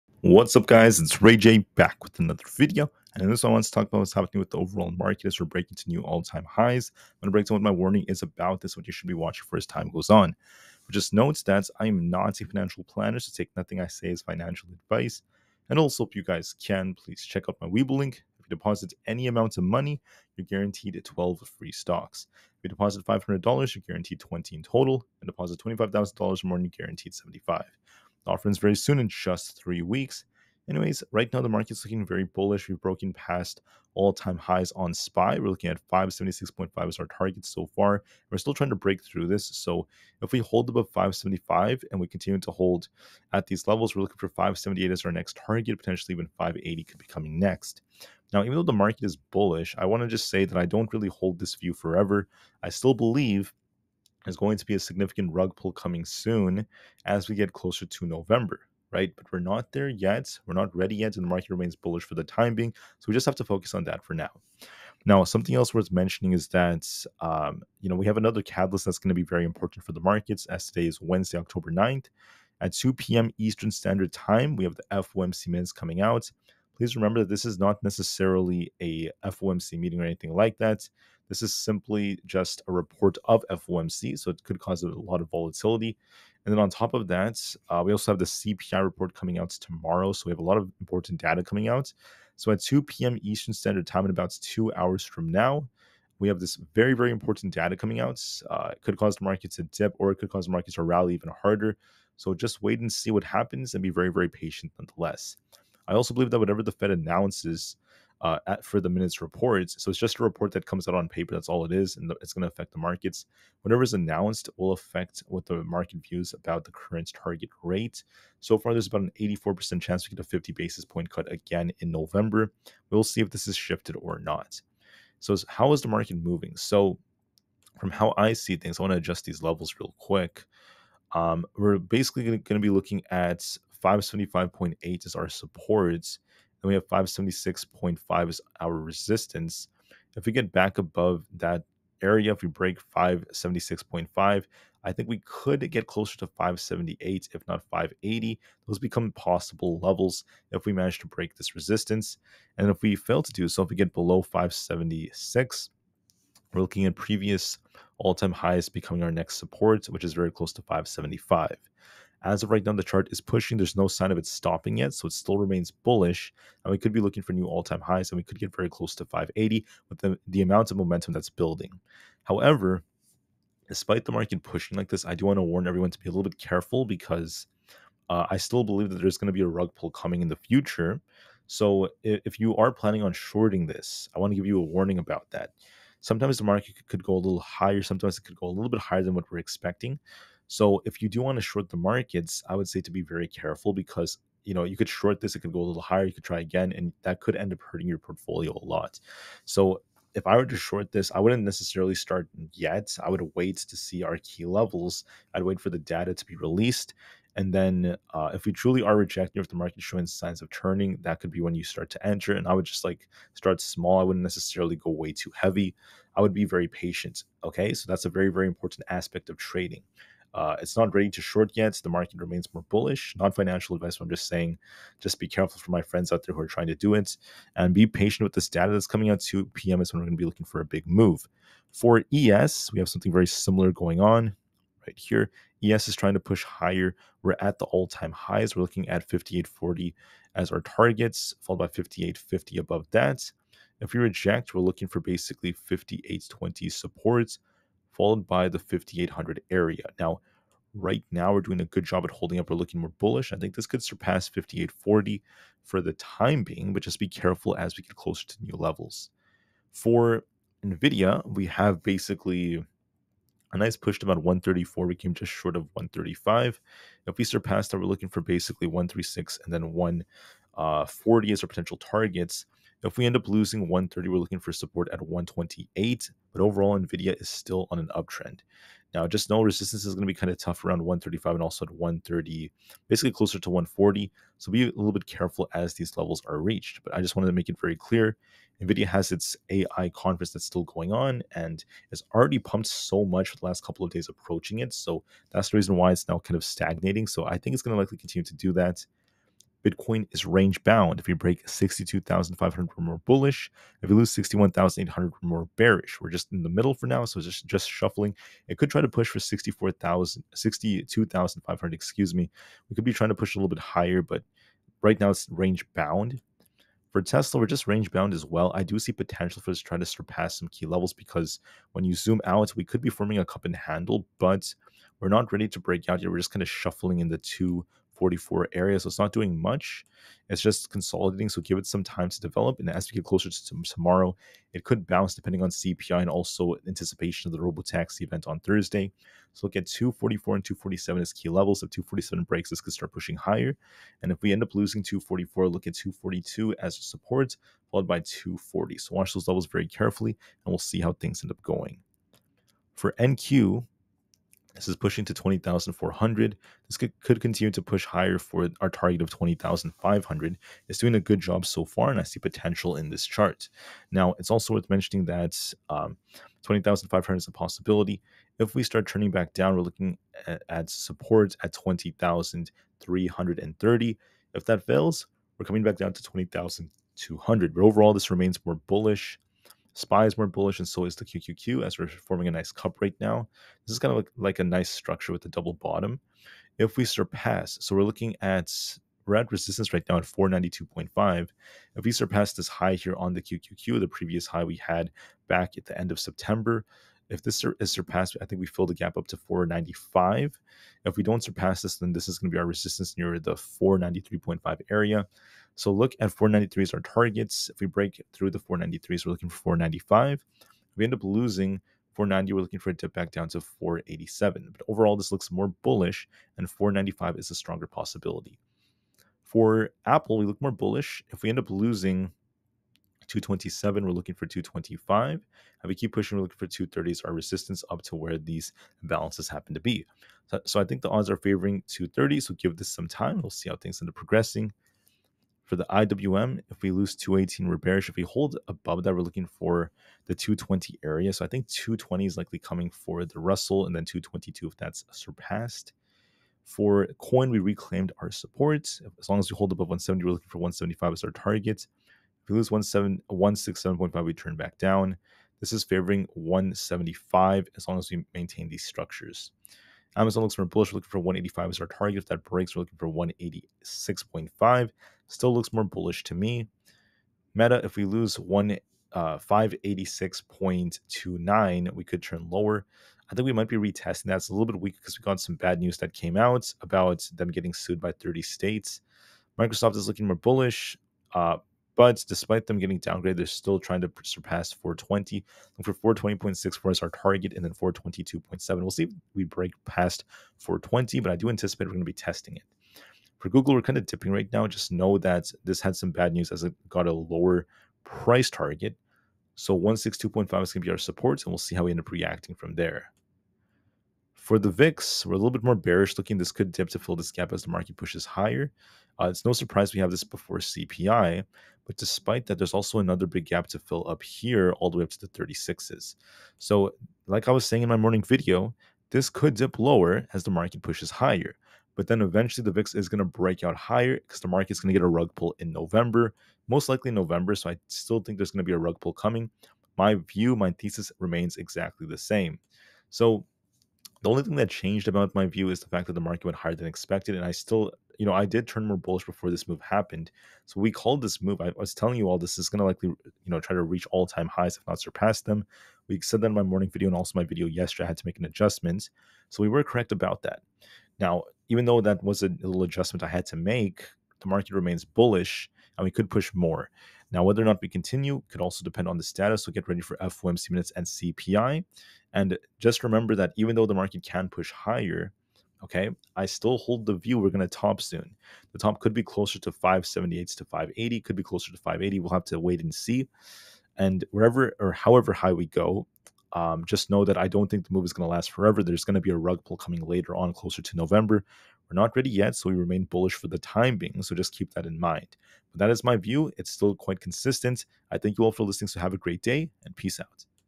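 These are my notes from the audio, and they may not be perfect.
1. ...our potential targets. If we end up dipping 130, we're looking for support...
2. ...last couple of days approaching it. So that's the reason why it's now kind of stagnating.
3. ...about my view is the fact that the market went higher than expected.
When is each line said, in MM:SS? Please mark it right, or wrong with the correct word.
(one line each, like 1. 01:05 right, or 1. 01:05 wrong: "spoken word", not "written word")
1. 04:31 wrong: "losing", not "dipping"
2. 04:53 right
3. 08:54 right.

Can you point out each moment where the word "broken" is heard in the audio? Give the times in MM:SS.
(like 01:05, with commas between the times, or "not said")
00:32.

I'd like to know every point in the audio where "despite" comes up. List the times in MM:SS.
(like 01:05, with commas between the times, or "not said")
02:53, 08:02, 08:31.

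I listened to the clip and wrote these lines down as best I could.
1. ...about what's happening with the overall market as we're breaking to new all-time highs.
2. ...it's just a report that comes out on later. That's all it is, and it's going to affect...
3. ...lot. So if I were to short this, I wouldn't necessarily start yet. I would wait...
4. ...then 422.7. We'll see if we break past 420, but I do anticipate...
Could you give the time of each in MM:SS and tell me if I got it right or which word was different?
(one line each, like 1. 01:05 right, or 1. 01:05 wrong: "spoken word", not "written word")
1. 00:03 right
2. 01:49 wrong: "paper", not "later"
3. 03:18 right
4. 08:07 right.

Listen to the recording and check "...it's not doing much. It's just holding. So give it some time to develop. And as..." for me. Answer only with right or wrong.
wrong.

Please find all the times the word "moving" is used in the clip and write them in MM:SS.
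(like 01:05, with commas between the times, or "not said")
02:06.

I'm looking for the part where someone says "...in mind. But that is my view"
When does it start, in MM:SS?
09:44.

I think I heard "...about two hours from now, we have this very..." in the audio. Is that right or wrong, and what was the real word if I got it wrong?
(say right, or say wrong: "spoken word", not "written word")
right.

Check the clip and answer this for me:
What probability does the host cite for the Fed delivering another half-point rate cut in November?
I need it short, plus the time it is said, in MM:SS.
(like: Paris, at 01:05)
84%, at 01:59.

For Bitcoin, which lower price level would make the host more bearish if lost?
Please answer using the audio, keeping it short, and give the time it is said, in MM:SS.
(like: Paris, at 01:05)
61,800, at 05:04.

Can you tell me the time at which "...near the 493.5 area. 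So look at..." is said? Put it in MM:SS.
06:42.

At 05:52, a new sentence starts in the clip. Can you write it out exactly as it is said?
For NQ, this is pushing to 20,400.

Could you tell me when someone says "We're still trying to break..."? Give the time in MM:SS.
00:38.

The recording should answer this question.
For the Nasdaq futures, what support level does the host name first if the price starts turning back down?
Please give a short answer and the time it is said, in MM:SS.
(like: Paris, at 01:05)
20,330, at 06:11.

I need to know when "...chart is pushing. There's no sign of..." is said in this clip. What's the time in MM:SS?
02:42.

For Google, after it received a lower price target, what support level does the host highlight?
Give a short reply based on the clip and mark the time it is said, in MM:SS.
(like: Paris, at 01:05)
162.5, at 08:19.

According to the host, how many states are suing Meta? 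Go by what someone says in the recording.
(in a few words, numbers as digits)
30.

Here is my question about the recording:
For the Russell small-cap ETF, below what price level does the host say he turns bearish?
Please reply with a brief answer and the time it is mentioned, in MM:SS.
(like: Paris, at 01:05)
218, at 07:16.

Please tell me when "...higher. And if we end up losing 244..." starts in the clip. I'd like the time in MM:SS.
05:43.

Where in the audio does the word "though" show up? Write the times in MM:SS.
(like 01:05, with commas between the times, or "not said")
00:48, 09:11, 09:23.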